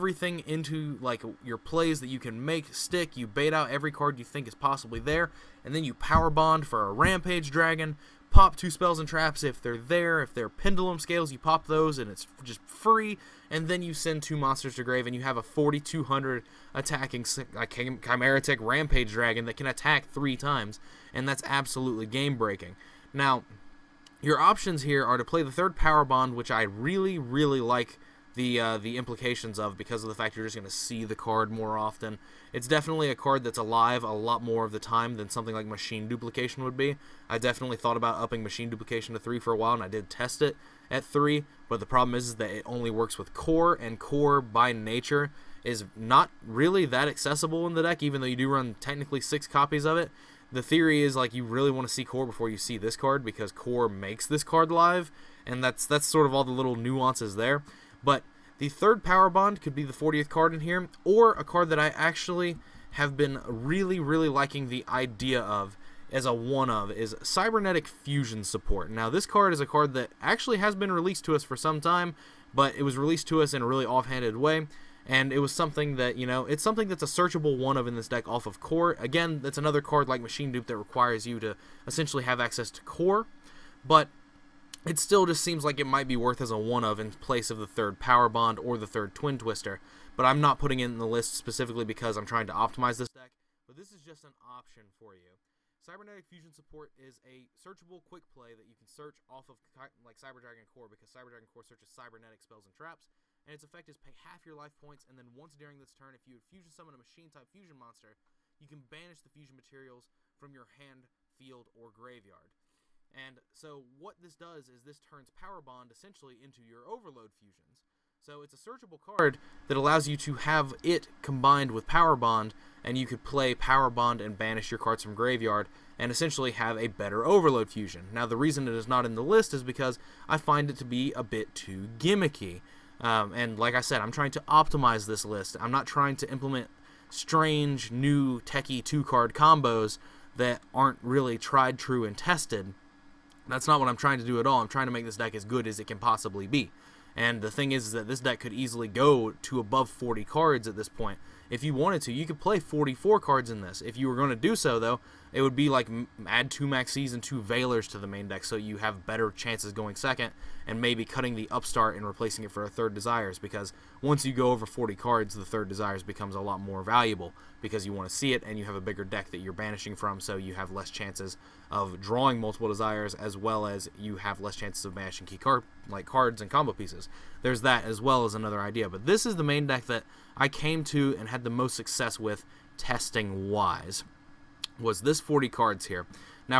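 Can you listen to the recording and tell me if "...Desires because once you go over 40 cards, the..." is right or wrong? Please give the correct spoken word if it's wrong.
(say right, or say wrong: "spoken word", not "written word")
right.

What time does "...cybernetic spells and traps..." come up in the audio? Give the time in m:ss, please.
1:41.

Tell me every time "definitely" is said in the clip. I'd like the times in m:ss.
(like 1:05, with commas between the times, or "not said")
0:32, 0:37.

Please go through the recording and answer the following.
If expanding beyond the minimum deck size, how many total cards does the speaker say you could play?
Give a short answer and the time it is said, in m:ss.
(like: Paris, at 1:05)
44, at 2:32.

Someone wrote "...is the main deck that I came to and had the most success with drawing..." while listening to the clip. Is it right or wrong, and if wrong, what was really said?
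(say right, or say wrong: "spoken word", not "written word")
wrong: "testing", not "drawing".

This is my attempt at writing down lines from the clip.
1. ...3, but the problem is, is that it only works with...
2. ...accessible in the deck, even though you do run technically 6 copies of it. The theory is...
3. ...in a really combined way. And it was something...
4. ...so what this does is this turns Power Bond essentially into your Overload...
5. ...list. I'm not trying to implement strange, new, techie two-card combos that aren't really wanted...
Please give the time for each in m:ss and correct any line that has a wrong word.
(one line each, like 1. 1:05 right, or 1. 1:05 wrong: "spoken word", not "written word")
1. 0:41 right
2. 0:47 right
3. 1:13 wrong: "offhanded", not "combined"
4. 1:53 right
5. 2:15 wrong: "tried", not "wanted".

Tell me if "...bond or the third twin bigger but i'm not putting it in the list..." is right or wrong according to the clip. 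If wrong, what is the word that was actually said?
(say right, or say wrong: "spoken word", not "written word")
wrong: "twister", not "bigger".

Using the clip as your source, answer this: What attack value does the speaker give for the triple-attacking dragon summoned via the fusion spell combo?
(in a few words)
4200.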